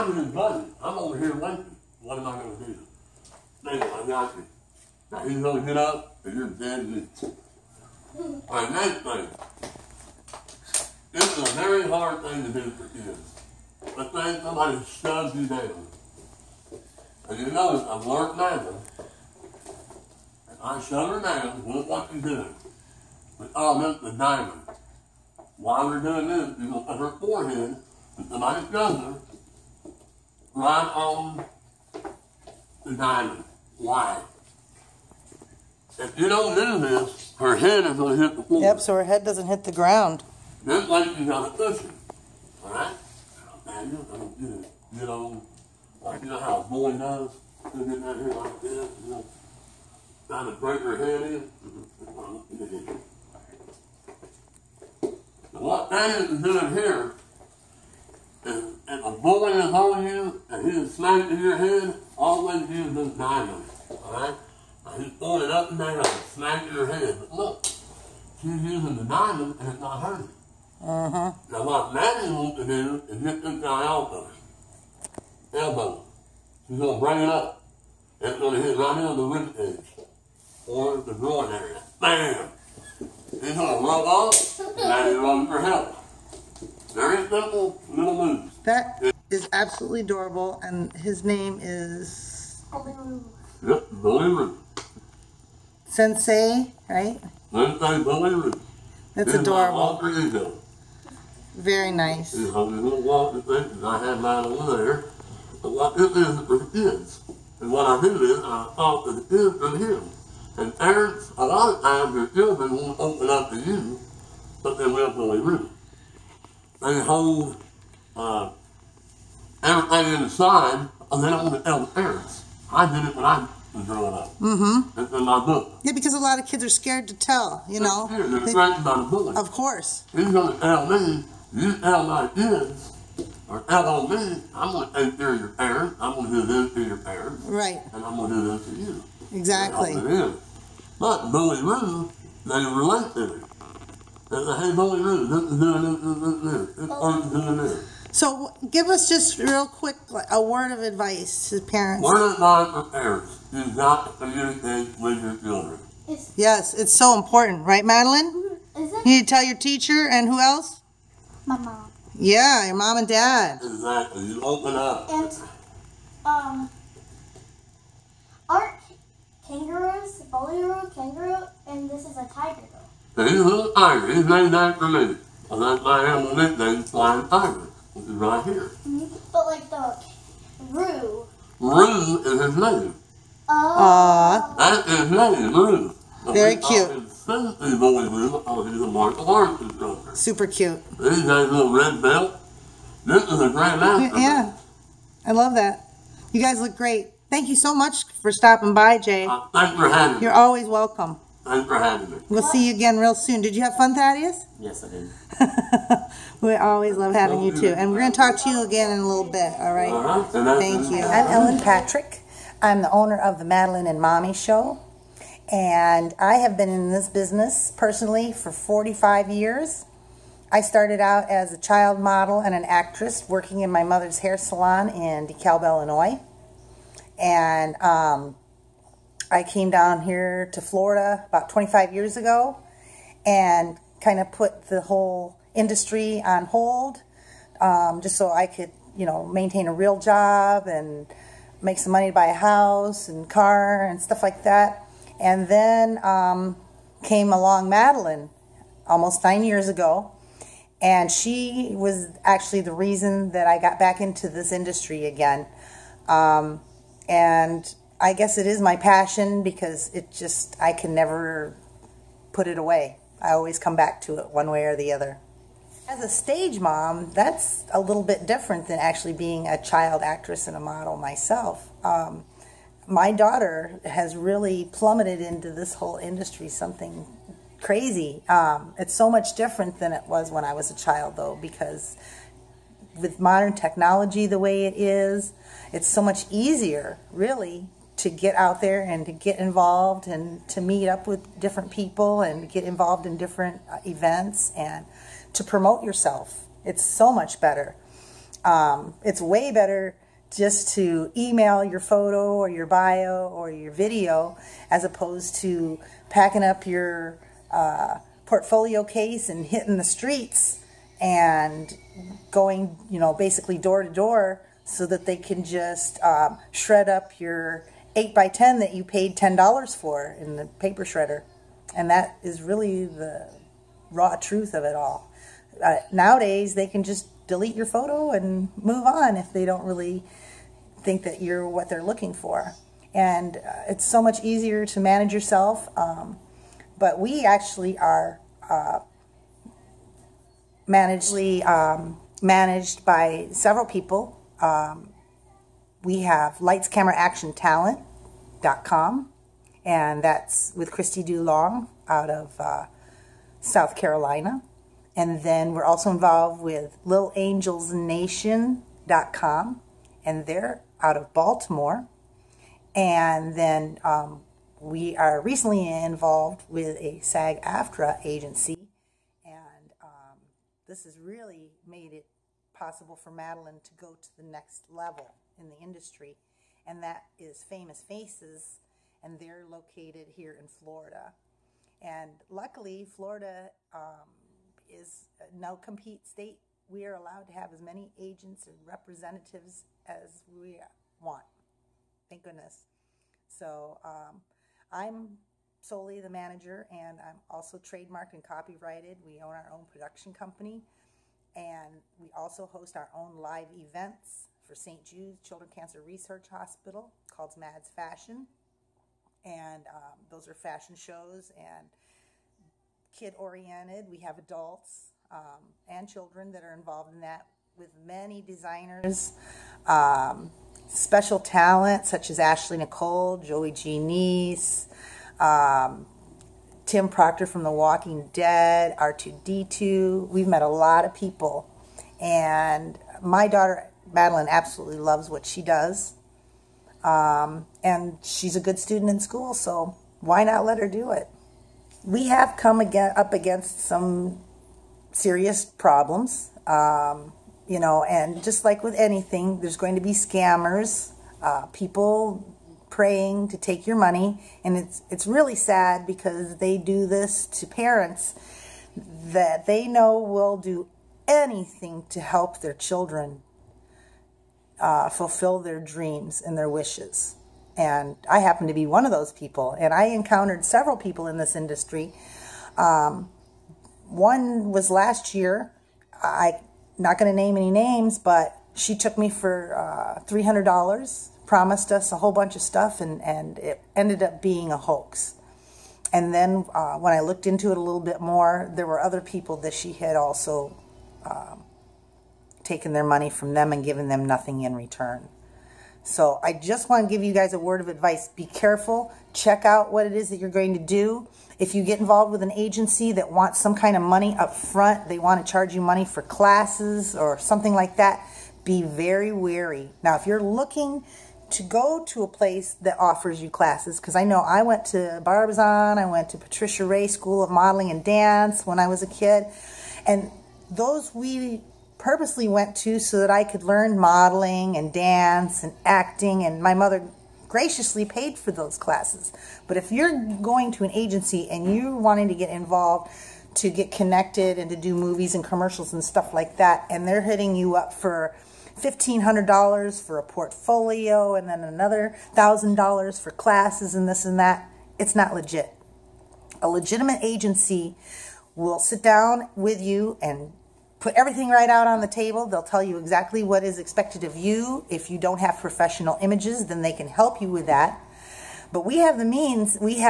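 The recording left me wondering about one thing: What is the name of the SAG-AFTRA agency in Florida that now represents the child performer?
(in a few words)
Famous Faces.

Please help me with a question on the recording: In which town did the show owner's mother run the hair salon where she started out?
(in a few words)
DeKalb, Illinois.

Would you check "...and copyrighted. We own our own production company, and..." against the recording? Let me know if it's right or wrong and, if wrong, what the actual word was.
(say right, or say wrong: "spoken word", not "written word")
right.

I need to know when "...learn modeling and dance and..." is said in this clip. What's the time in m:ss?
8:43.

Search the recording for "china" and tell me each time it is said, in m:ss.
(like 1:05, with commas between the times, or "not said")
not said.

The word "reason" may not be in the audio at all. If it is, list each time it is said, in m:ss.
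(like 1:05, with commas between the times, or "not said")
4:12.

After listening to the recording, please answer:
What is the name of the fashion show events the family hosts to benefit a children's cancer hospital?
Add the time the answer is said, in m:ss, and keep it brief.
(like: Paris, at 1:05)
Mads Fashion, at 6:47.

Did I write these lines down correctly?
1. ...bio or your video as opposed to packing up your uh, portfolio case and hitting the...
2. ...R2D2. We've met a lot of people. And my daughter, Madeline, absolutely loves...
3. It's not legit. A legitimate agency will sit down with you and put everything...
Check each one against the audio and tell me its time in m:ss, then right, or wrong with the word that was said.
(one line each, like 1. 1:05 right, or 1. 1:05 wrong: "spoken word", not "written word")
1. 5:02 right
2. 7:08 right
3. 9:04 right.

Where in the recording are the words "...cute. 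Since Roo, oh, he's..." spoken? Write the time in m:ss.
3:06.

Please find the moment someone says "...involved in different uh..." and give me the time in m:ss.
4:52.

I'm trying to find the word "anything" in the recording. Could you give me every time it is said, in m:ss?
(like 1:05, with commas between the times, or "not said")
7:28, 7:41.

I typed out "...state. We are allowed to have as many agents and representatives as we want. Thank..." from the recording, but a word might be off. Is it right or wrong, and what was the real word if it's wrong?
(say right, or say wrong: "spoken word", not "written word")
right.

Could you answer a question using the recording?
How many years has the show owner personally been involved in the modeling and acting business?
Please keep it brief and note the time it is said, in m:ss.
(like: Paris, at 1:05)
45 years, at 3:38.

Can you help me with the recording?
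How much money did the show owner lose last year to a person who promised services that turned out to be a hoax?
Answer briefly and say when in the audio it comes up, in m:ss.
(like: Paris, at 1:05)
$300, at 8:00.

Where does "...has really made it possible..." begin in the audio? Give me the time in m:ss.
6:10.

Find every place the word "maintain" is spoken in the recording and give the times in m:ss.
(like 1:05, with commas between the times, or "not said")
3:59.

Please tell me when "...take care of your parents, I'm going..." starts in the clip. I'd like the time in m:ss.
2:15.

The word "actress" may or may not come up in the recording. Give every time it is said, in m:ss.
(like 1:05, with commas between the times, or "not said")
3:42, 4:30.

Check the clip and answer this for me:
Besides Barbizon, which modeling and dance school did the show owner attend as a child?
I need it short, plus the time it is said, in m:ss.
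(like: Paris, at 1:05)
Patricia Ray School of Modeling and Dance, at 8:36.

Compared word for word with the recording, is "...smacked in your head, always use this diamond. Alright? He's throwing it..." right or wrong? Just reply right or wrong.
right.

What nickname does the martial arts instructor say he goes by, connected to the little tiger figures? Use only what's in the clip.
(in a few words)
Flying Tiger.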